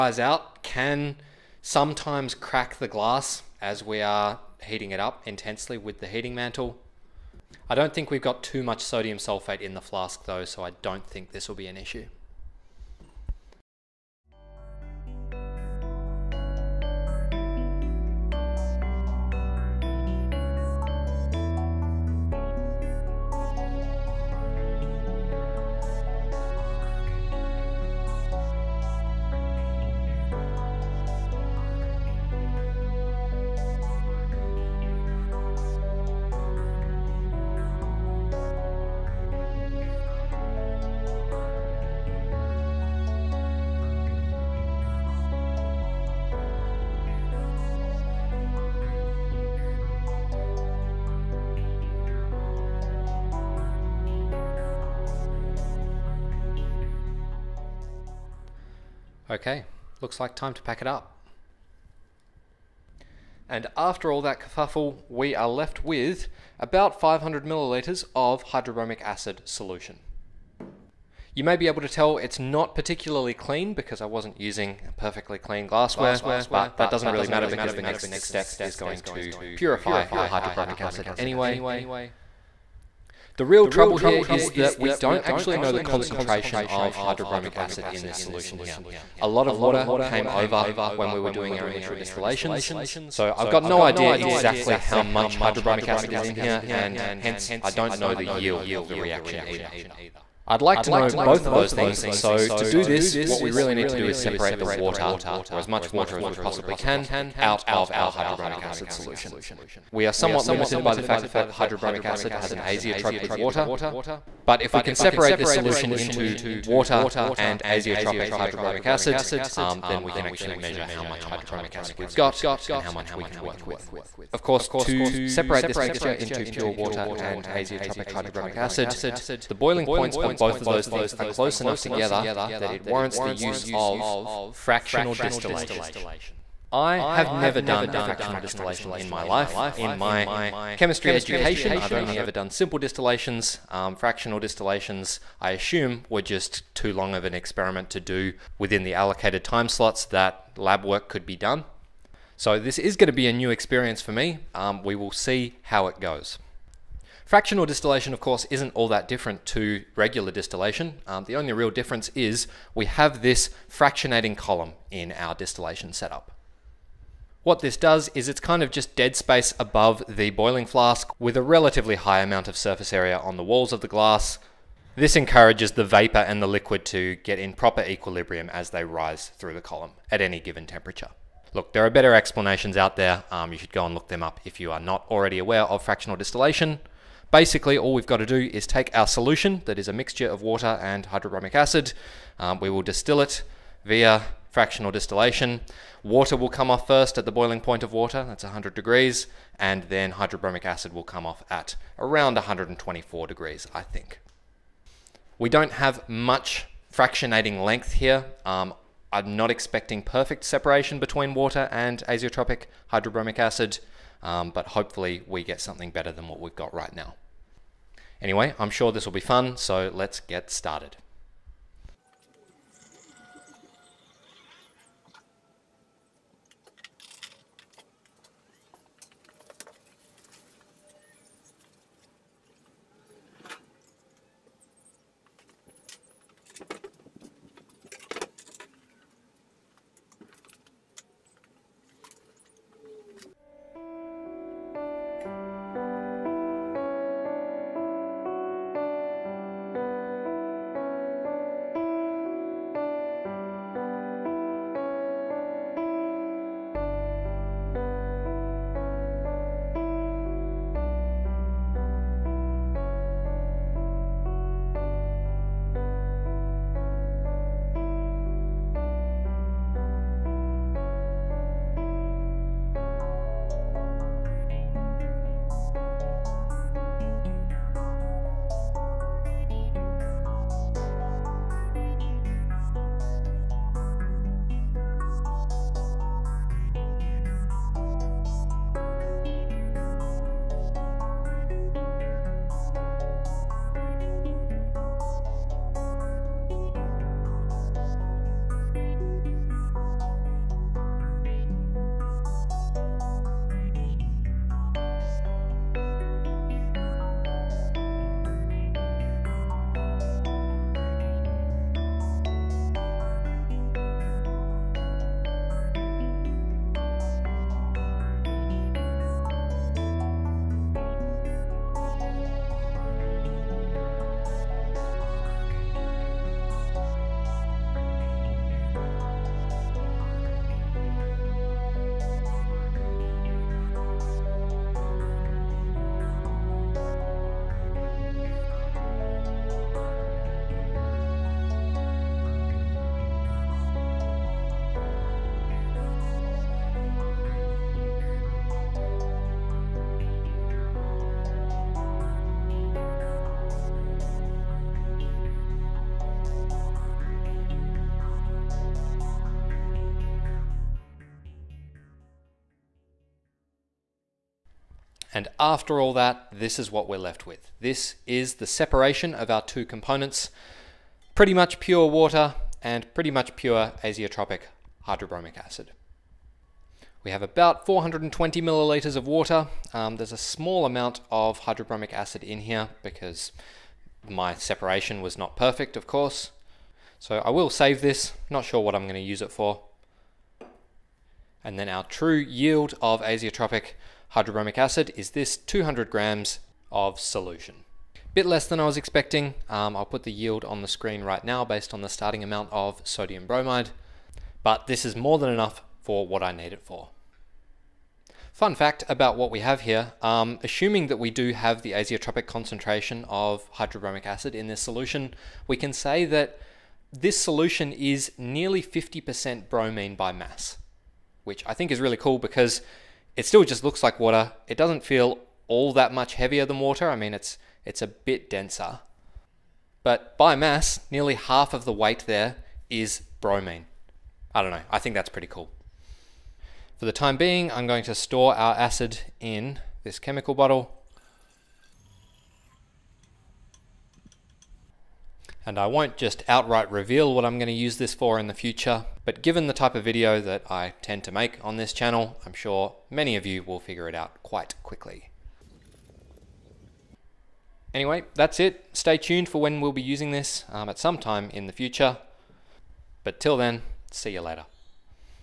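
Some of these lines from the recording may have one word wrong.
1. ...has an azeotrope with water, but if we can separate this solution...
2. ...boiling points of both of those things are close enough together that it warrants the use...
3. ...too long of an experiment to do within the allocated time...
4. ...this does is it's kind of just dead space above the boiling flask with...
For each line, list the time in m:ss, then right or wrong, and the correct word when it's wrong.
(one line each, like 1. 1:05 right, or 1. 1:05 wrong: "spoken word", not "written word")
1. 1:52 right
2. 2:09 right
3. 2:26 right
4. 2:47 right.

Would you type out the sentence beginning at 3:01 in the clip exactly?
Look, there are better explanations out there.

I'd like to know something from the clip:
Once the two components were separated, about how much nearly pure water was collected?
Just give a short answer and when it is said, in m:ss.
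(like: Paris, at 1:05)
420 milliliters, at 6:17.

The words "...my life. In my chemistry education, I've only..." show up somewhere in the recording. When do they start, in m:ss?
2:19.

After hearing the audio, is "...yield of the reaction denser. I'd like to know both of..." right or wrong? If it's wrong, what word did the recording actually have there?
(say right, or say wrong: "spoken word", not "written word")
wrong: "either", not "denser".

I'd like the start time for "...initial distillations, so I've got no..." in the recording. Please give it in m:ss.
1:31.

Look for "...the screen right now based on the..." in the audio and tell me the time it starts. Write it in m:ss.
6:40.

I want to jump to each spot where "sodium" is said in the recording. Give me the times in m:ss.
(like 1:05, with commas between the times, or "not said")
0:08, 6:42.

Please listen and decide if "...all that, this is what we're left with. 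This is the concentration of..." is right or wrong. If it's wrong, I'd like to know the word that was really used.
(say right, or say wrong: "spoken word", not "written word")
wrong: "separation", not "concentration".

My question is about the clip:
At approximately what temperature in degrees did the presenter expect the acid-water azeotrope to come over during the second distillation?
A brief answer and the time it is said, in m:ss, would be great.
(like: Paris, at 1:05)
124 degrees, at 3:22.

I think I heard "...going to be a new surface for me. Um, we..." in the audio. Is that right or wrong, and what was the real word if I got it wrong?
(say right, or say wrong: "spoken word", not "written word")
wrong: "experience", not "surface".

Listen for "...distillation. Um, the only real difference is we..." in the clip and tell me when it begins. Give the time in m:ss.
2:40.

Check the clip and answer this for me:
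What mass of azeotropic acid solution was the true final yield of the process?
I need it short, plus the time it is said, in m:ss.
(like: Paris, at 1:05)
200 grams, at 6:35.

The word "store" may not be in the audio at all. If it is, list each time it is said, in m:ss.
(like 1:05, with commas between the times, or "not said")
7:17.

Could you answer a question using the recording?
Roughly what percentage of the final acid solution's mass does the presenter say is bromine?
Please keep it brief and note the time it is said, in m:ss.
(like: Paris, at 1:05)
50%, at 6:58.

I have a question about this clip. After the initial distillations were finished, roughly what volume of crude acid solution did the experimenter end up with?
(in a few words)
500 milliliters.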